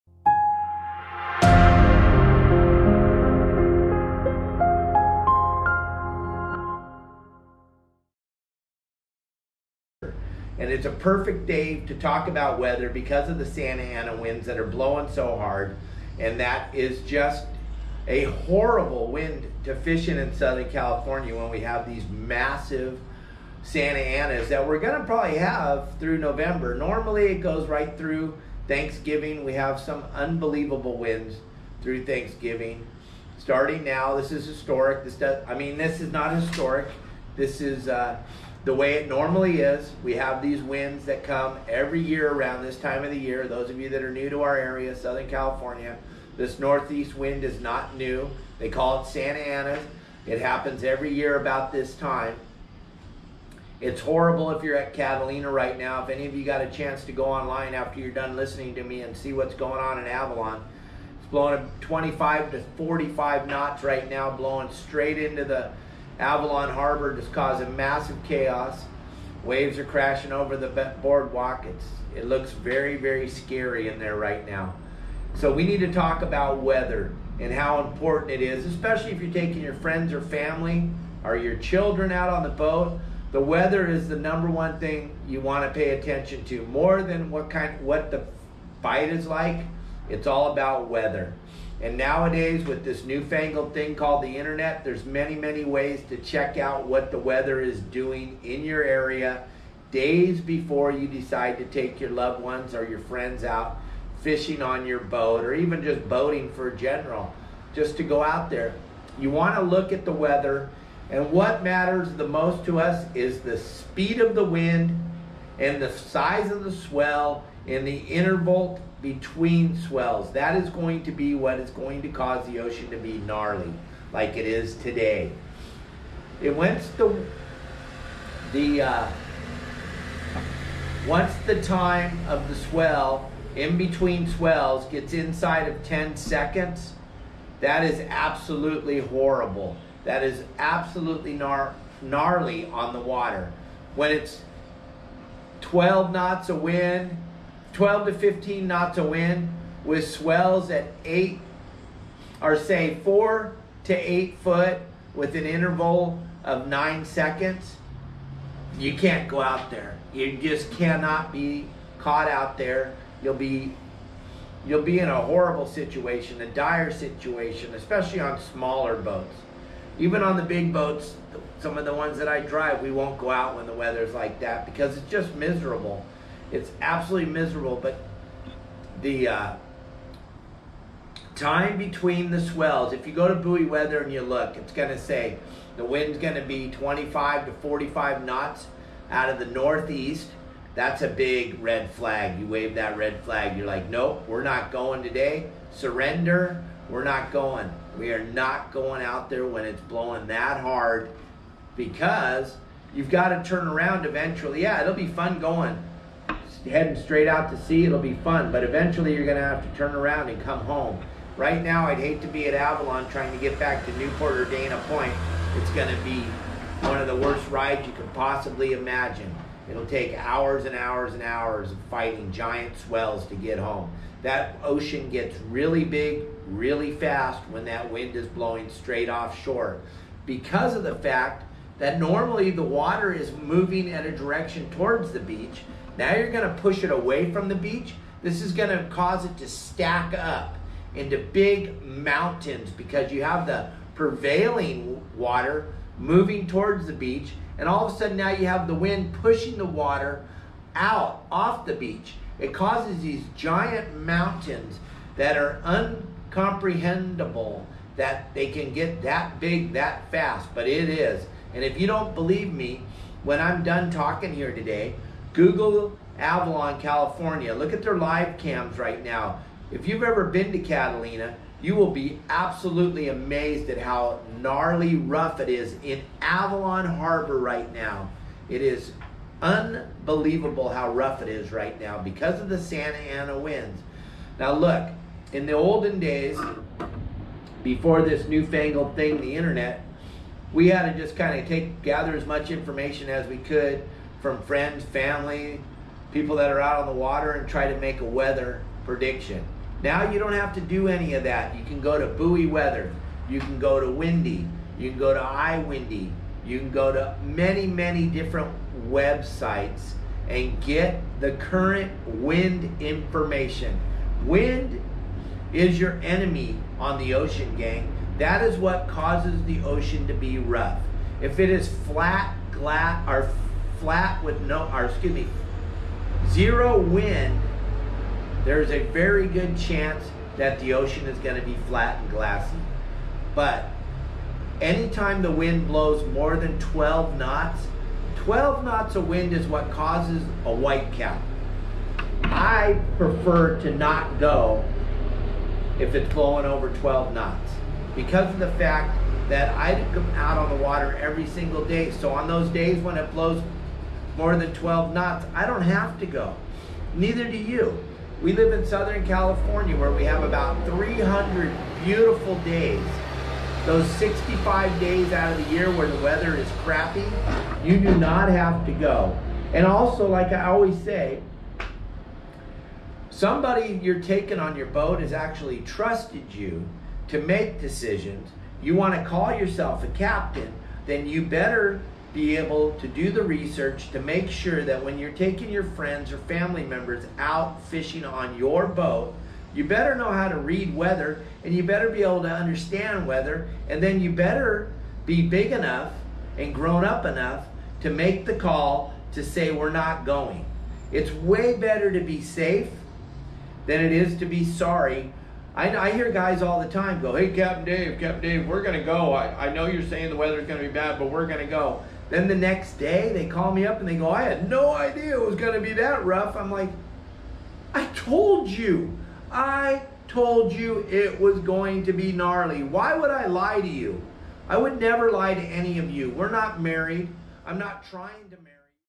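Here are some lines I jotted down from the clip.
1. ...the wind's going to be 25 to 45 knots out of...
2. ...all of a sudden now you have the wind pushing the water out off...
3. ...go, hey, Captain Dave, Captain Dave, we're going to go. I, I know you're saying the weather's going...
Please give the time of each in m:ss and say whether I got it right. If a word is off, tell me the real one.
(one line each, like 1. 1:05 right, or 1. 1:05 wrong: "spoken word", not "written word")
1. 3:05 right
2. 4:07 right
3. 6:47 right.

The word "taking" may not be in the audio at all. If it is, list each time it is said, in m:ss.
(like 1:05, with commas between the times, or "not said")
1:19, 6:14, 6:25.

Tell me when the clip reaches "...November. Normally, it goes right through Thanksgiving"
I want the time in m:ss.
0:26.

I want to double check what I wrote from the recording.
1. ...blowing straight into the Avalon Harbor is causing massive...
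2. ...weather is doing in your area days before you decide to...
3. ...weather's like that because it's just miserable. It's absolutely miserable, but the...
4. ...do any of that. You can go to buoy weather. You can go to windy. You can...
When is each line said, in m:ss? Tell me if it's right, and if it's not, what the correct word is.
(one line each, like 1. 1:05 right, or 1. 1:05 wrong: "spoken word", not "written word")
1. 1:04 right
2. 1:37 right
3. 2:53 right
4. 5:00 right.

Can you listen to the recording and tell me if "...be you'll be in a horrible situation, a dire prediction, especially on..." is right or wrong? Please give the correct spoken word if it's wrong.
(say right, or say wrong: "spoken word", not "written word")
wrong: "situation", not "prediction".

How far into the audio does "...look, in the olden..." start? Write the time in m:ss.
4:44.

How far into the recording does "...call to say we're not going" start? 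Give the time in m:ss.
6:38.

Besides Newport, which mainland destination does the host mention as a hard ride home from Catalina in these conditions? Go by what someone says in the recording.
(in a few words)
Dana Point.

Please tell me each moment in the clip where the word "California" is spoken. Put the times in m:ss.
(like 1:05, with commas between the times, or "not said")
0:20, 0:45, 4:26, 5:59.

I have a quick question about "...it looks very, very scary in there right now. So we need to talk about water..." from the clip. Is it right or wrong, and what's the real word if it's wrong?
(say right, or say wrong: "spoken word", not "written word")
wrong: "weather", not "water".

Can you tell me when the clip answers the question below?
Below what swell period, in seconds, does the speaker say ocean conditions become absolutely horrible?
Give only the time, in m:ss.
2:15.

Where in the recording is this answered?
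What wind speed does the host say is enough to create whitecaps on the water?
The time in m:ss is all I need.
5:38.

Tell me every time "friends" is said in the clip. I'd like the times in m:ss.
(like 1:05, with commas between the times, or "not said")
1:19, 1:42, 4:54, 6:25.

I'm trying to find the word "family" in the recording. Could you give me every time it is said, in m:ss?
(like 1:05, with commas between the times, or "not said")
1:20, 4:54, 6:26.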